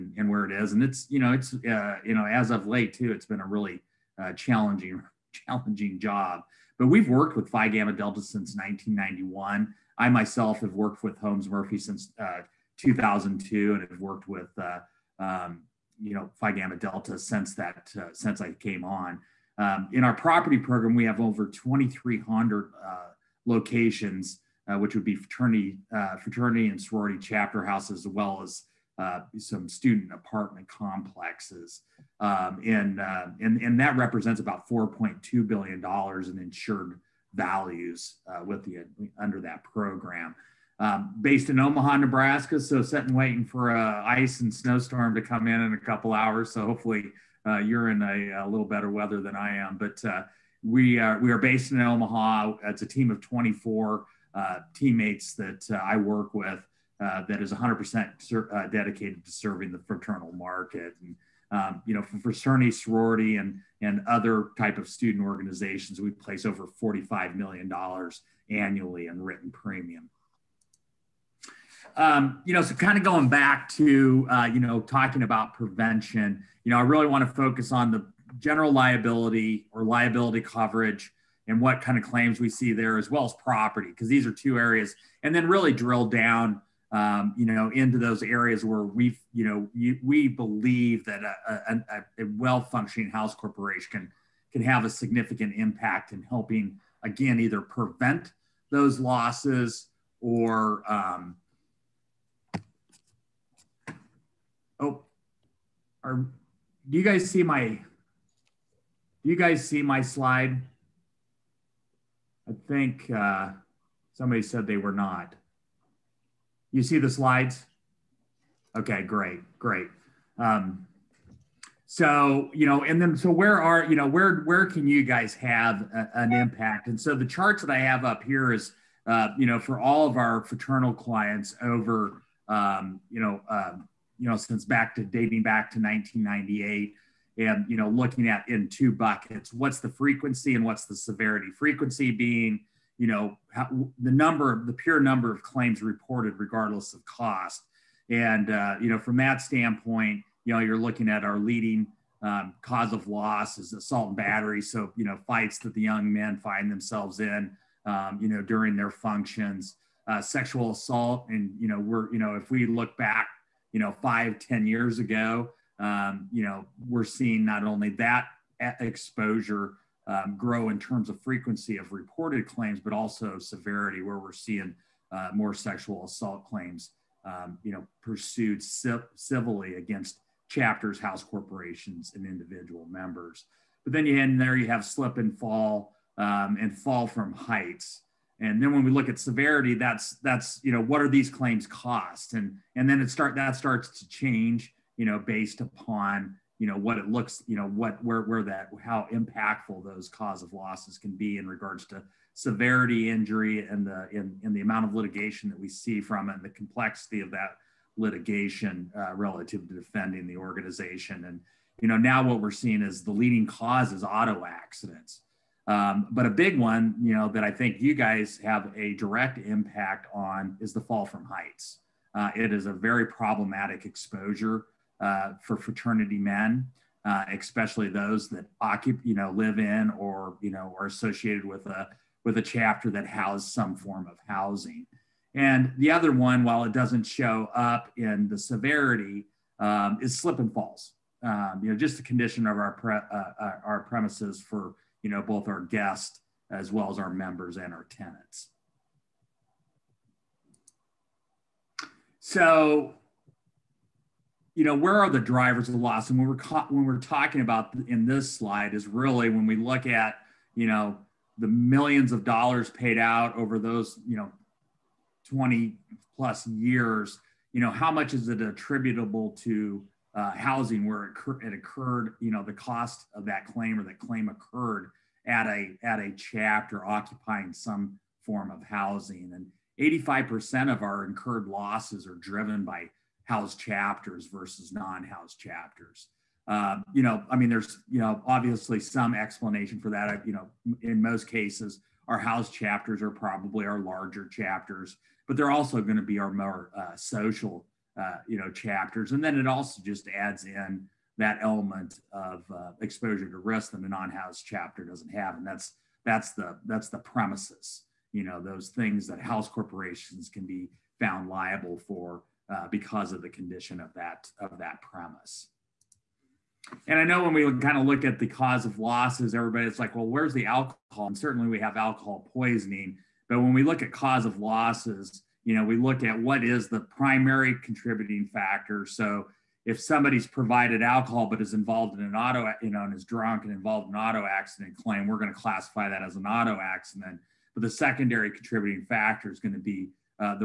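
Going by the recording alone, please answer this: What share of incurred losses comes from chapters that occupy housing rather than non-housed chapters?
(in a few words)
85%.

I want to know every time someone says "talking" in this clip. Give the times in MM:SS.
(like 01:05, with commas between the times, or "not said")
01:14, 04:16.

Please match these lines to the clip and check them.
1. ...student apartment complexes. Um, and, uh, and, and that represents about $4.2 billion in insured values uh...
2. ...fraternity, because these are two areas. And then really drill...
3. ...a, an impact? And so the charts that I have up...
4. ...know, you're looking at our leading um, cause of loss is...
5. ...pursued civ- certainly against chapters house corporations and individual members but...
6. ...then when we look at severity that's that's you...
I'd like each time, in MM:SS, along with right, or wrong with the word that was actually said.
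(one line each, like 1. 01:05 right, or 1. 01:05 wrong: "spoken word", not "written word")
1. 00:29 right
2. 01:23 wrong: "property", not "fraternity"
3. 02:05 right
4. 02:30 right
5. 02:58 wrong: "civilly", not "certainly"
6. 03:08 right.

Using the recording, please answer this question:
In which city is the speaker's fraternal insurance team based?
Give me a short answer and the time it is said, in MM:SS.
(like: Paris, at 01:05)
Omaha, Nebraska, at 00:41.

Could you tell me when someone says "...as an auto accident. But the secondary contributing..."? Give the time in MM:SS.
05:36.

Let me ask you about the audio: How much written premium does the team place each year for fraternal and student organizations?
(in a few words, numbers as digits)
$45 million.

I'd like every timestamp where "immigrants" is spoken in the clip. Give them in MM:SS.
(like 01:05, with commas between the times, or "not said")
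not said.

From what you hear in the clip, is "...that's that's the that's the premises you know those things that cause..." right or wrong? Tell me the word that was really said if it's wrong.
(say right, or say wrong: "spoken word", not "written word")
wrong: "house", not "cause".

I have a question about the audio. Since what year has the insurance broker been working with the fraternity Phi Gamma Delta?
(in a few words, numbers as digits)
1991.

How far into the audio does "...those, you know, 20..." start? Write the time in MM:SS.
04:23.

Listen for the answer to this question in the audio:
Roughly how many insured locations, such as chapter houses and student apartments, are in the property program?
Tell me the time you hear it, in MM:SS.
00:21.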